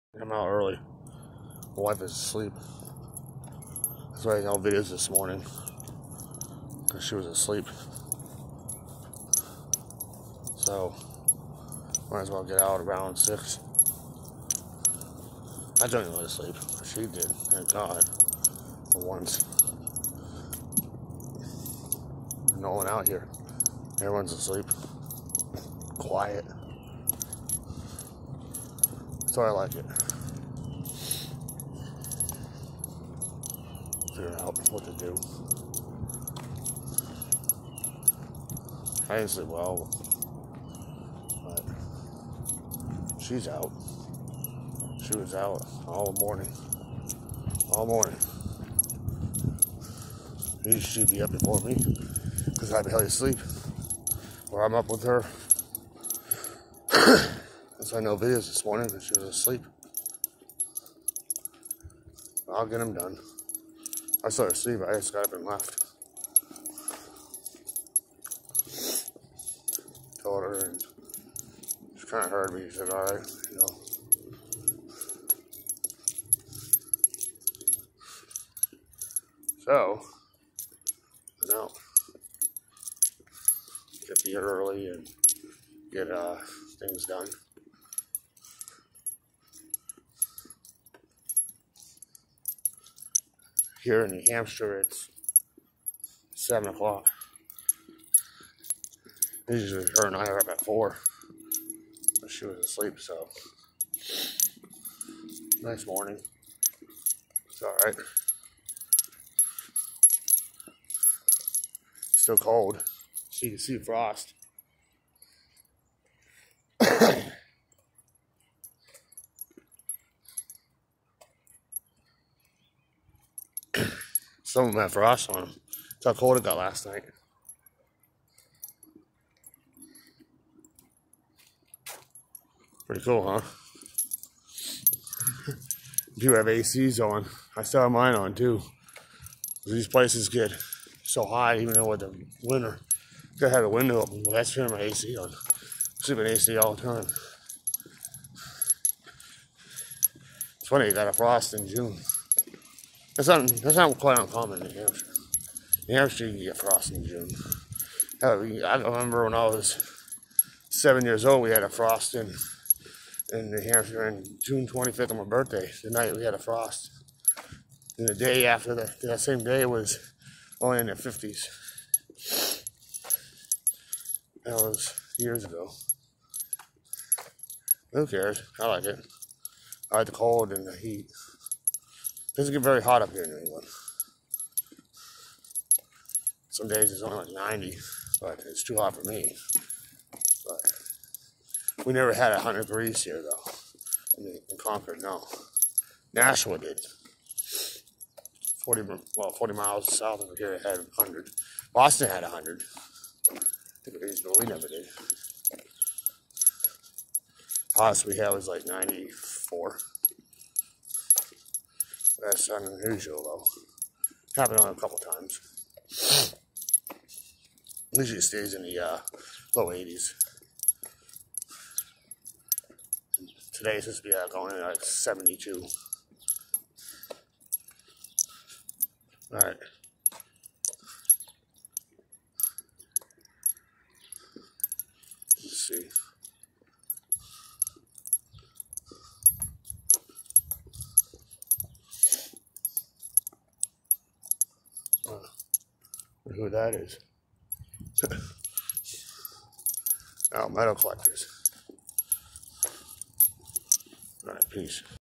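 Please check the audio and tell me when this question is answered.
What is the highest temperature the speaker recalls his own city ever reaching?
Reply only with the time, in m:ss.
3:28.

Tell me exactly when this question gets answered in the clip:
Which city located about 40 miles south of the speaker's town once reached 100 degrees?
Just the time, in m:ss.
3:16.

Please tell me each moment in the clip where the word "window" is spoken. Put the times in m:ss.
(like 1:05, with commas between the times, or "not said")
2:23.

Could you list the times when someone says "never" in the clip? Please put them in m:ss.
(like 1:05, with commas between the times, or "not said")
3:11, 3:24.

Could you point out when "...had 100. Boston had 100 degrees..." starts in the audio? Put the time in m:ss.
3:20.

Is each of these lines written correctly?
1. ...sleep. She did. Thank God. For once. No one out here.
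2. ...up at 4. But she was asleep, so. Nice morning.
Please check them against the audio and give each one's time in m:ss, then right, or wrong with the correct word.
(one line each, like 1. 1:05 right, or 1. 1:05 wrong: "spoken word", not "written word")
1. 0:16 right
2. 1:40 right.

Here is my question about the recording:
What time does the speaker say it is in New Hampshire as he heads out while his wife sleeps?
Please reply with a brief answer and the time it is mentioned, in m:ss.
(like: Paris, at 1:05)
7 o'clock, at 1:36.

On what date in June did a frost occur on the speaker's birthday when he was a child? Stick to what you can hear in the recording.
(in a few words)
June 25th.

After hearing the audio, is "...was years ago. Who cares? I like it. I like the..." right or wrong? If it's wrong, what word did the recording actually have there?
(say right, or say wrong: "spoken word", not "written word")
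right.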